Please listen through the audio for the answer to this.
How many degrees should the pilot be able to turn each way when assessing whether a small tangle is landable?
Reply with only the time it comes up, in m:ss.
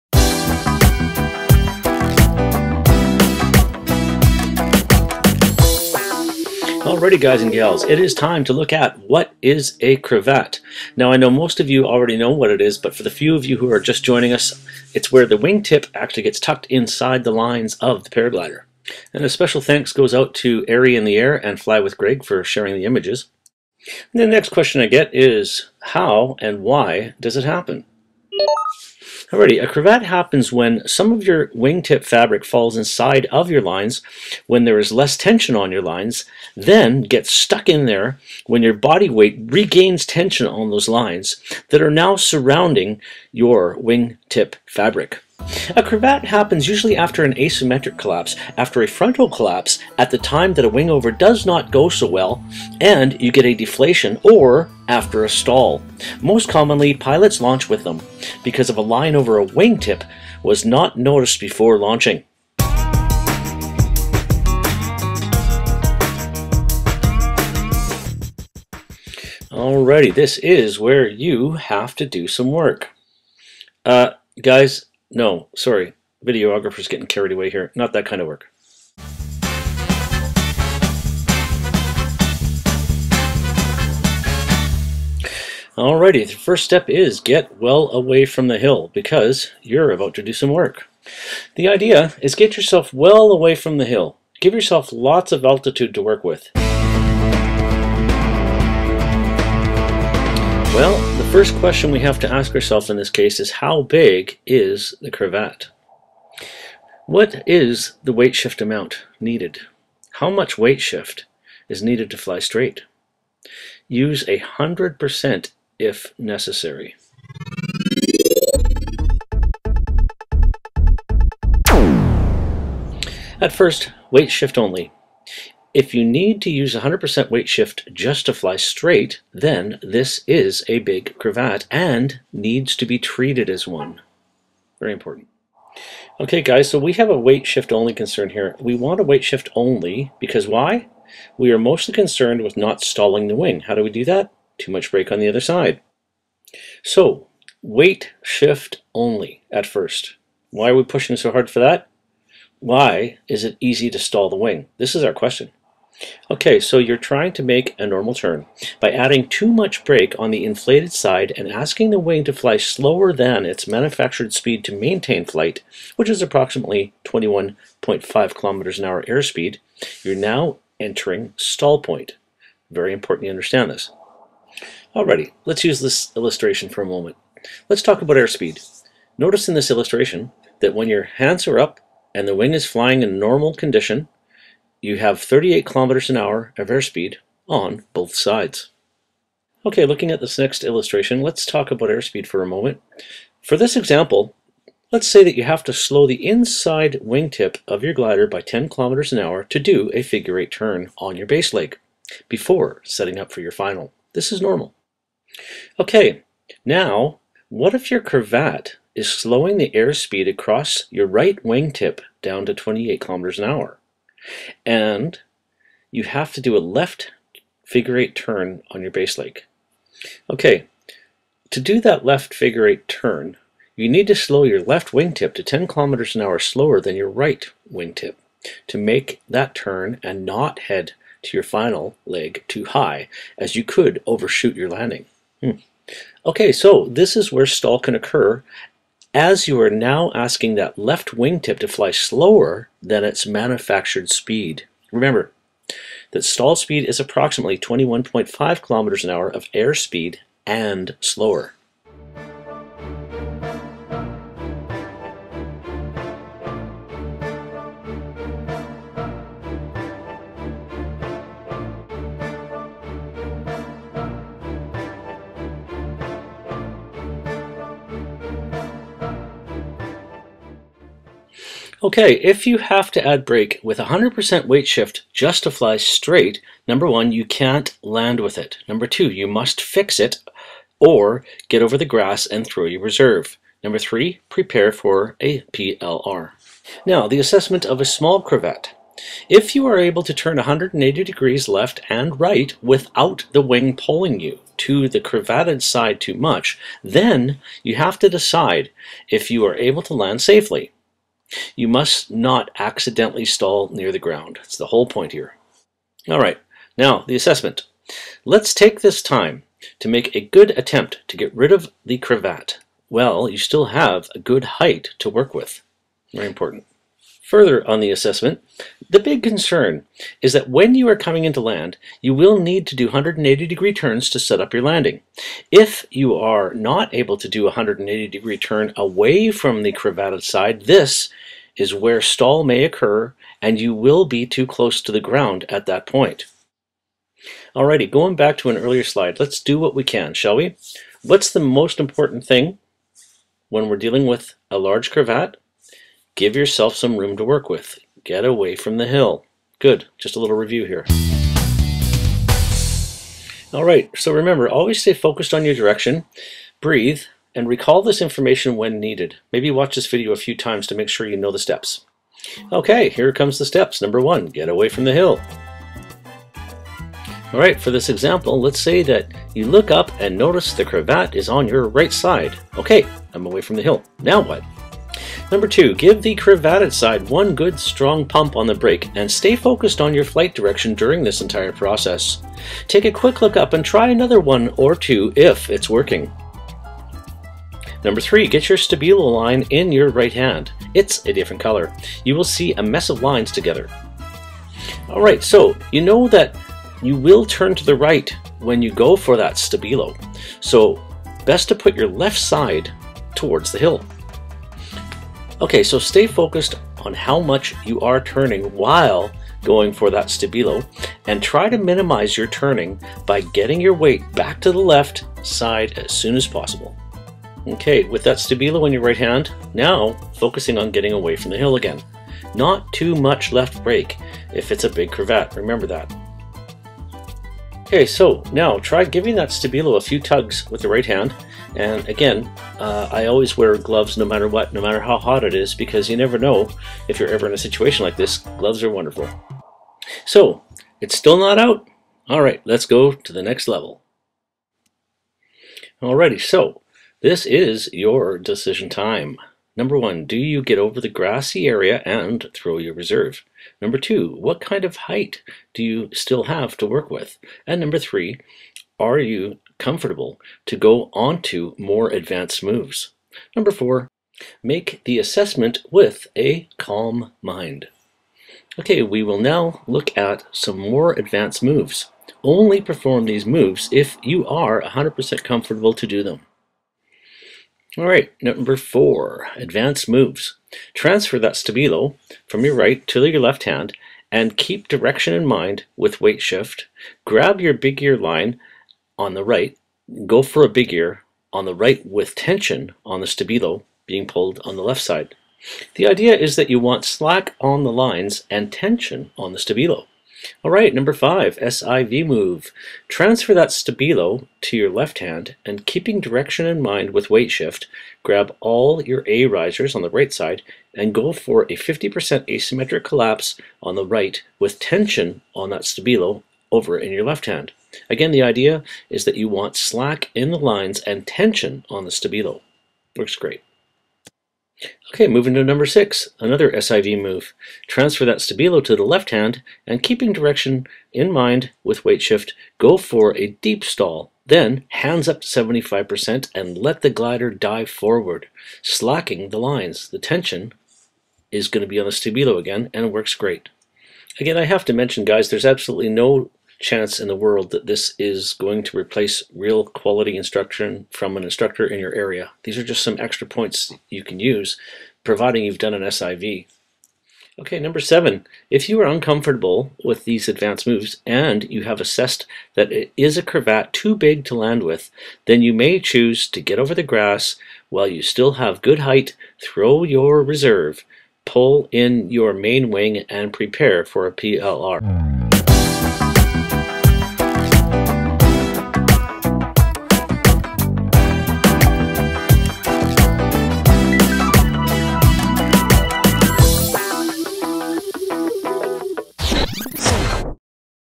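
4:50.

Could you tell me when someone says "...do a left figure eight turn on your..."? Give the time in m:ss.
3:36.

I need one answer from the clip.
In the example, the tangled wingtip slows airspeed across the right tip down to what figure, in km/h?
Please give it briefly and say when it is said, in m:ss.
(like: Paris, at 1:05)
28, at 3:32.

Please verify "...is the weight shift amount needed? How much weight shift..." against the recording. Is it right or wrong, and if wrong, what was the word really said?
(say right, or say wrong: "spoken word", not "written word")
right.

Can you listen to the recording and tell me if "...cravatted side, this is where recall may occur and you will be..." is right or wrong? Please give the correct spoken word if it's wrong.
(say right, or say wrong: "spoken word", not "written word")
wrong: "stall", not "recall".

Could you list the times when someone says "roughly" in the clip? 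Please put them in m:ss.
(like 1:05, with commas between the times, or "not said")
not said.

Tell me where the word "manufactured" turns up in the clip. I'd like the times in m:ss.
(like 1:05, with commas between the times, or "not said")
2:43, 4:03.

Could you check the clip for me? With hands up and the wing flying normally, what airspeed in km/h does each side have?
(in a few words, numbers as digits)
38.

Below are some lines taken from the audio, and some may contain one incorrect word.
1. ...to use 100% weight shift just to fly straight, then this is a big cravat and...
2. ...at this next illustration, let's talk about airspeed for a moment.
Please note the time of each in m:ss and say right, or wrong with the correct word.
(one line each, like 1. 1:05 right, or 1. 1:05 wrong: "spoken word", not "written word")
1. 2:06 right
2. 3:10 right.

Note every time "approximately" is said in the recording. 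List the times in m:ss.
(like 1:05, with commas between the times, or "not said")
2:46, 4:06.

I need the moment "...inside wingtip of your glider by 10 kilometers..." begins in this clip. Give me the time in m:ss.
3:16.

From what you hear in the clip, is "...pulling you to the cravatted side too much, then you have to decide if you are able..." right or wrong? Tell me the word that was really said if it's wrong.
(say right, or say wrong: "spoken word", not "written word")
right.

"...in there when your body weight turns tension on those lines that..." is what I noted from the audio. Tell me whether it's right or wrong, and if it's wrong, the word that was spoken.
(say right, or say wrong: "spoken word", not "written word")
wrong: "regains", not "turns".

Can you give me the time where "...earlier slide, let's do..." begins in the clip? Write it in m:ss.
5:38.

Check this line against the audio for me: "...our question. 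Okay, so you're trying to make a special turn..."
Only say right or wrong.
wrong.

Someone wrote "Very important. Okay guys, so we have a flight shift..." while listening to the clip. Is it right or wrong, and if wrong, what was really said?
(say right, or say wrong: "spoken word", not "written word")
wrong: "weight", not "flight".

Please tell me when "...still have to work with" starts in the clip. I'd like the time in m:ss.
7:35.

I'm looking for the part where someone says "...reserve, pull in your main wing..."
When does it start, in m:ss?
9:30.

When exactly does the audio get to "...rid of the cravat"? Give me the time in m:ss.
5:11.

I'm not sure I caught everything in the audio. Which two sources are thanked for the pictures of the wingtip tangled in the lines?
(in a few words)
Airy in the Air and Fly with Greg.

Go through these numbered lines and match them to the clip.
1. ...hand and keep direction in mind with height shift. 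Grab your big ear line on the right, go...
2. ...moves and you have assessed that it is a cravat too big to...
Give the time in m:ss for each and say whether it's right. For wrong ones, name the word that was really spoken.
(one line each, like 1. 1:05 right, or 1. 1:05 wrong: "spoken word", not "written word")
1. 8:03 wrong: "weight", not "height"
2. 9:20 right.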